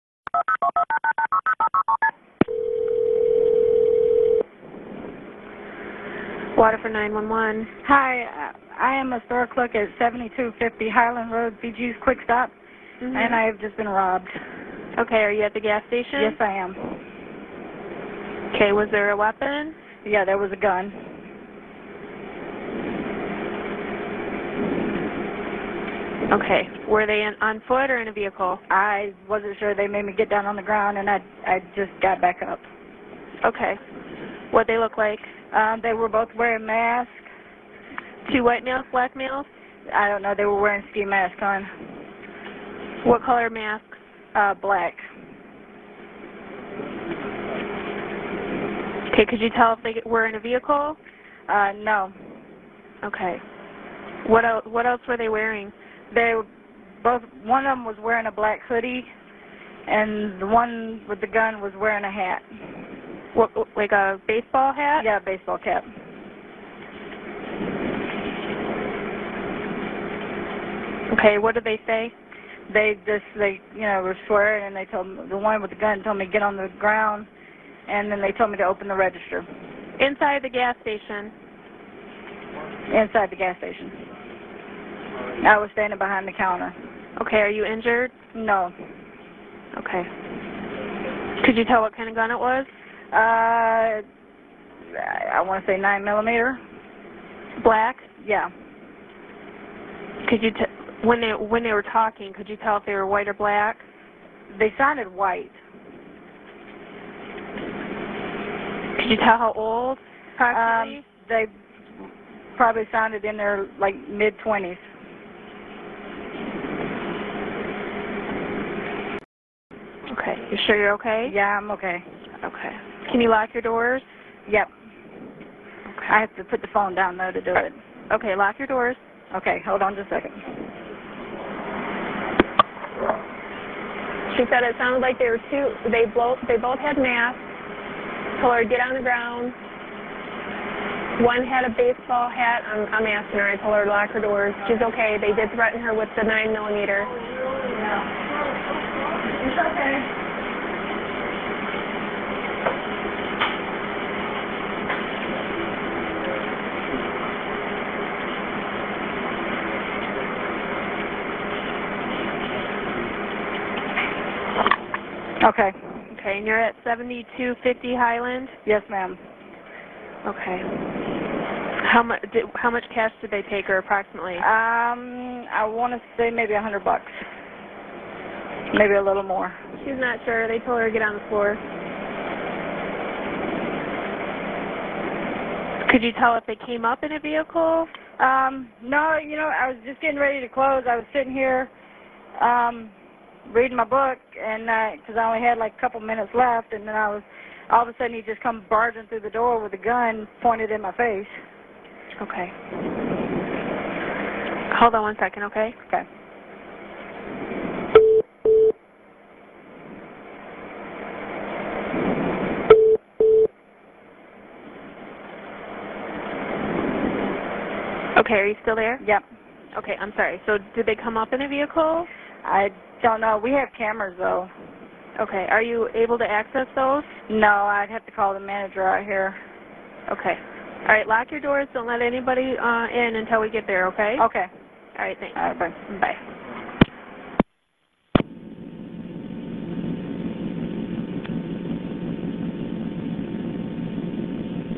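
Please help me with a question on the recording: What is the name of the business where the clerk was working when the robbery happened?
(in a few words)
BG's Quick Stop.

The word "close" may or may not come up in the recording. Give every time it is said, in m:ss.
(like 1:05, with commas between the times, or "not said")
3:10.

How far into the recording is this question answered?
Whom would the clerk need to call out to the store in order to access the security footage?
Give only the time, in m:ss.
3:48.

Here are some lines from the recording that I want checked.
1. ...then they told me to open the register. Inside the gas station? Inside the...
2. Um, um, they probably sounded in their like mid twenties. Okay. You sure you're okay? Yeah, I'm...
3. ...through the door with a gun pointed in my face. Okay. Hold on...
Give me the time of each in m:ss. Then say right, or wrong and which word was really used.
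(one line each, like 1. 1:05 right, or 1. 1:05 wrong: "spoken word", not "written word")
1. 1:18 right
2. 1:50 right
3. 3:19 right.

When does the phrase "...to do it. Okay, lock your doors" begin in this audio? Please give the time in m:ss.
2:07.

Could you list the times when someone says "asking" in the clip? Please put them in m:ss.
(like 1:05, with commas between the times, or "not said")
2:23.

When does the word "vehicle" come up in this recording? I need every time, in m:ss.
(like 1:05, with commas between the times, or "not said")
0:28, 0:50, 3:07, 3:41.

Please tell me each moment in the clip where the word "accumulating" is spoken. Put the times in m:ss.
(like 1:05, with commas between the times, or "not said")
not said.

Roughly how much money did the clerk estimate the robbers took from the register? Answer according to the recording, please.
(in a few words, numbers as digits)
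$100.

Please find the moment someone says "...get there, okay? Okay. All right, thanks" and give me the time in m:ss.
3:53.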